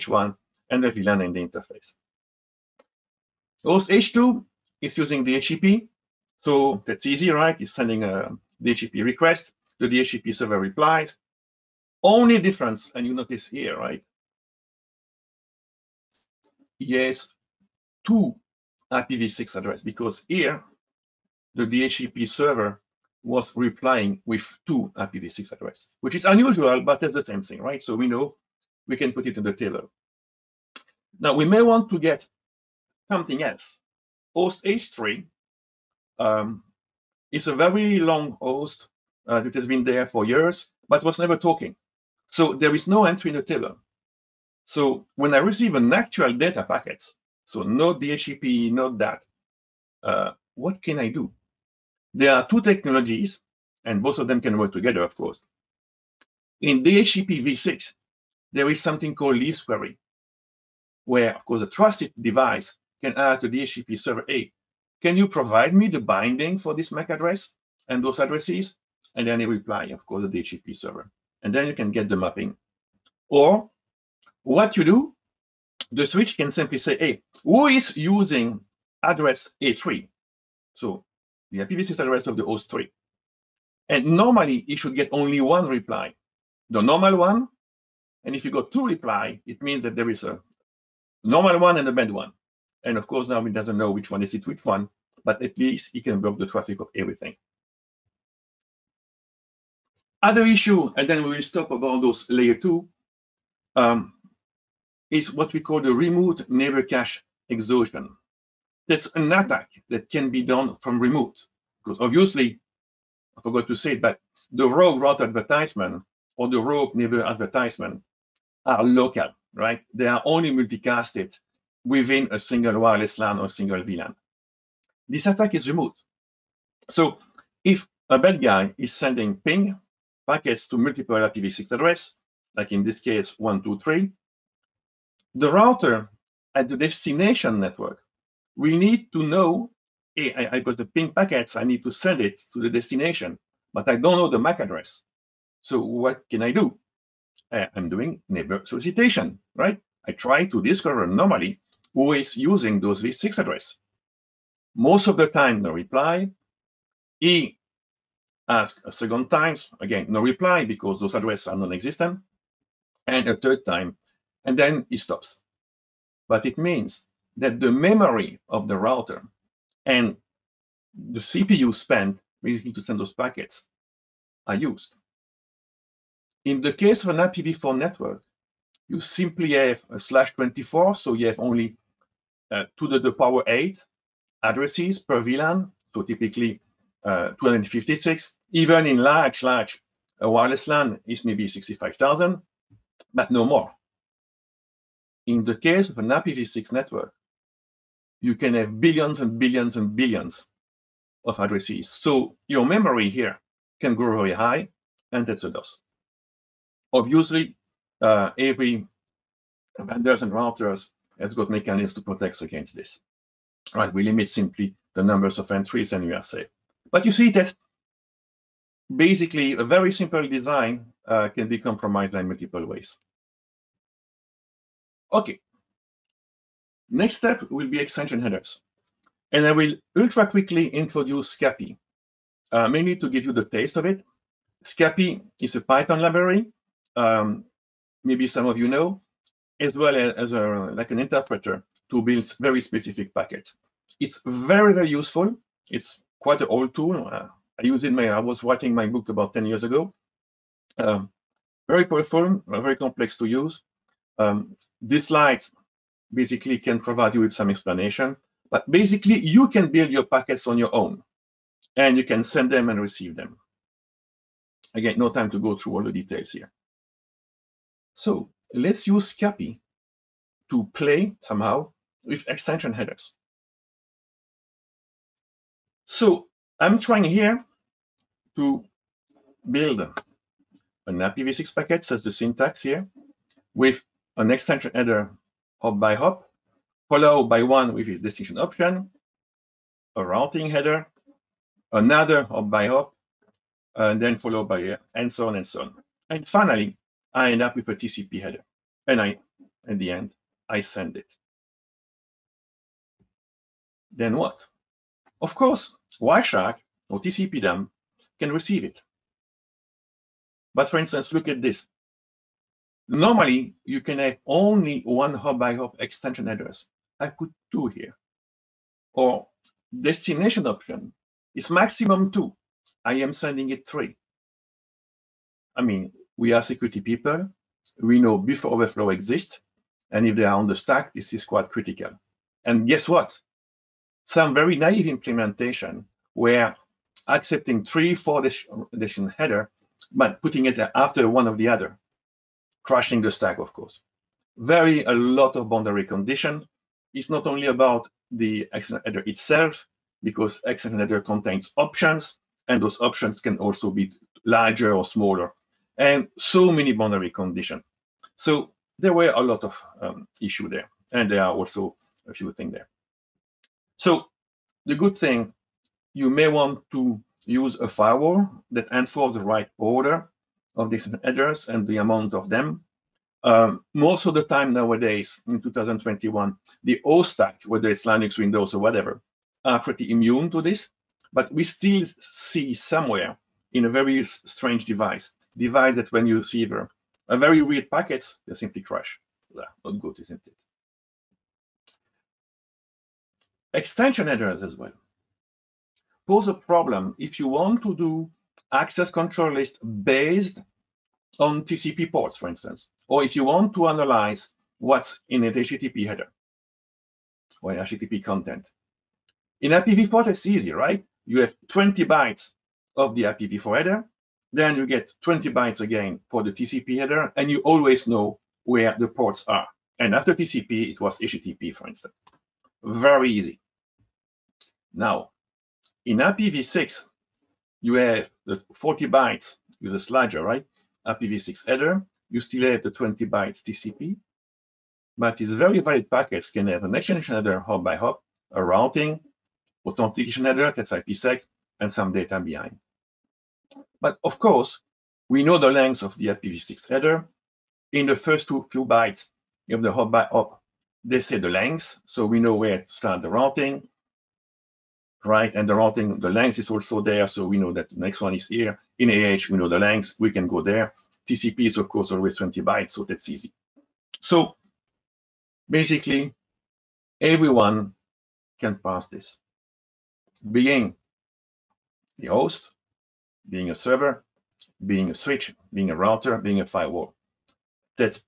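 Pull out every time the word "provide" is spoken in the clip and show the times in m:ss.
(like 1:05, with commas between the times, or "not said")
1:05, 4:16.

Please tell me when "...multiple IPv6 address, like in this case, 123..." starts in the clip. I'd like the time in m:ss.
2:10.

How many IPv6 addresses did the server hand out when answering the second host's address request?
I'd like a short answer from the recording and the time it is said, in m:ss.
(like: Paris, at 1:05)
2, at 0:18.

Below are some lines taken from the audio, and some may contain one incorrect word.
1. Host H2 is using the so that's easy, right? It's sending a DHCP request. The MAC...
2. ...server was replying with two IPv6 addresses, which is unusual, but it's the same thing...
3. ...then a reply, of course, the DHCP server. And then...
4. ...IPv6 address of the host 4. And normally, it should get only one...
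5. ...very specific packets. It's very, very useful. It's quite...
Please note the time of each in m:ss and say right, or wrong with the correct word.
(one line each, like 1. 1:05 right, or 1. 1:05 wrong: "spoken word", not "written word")
1. 0:03 wrong: "DHCP", not "MAC"
2. 0:22 right
3. 1:09 right
4. 1:21 wrong: "3", not "4"
5. 4:02 right.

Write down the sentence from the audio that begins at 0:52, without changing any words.
There are two technologies, and both of them can work together, of course.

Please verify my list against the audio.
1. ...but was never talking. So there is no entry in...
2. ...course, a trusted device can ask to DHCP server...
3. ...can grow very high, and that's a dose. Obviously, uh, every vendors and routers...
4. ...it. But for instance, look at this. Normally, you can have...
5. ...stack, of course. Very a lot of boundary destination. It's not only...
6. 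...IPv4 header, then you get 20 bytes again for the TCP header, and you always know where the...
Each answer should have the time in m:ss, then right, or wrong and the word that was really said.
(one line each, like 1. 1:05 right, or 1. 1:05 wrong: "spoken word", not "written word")
1. 0:40 right
2. 1:01 right
3. 3:23 right
4. 5:08 right
5. 5:43 wrong: "condition", not "destination"
6. 6:53 right.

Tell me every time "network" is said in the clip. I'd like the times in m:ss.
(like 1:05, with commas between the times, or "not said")
2:17, 2:57, 3:16.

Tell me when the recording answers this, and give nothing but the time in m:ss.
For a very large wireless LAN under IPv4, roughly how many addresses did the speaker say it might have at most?
3:11.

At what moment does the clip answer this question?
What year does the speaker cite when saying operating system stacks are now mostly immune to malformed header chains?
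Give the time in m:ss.
6:15.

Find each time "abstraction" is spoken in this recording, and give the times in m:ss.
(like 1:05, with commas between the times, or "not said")
not said.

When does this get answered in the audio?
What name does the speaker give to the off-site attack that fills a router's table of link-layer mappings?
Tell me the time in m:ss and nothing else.
1:45.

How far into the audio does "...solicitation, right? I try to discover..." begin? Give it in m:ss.
2:28.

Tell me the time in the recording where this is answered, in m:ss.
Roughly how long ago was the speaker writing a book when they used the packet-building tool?
4:09.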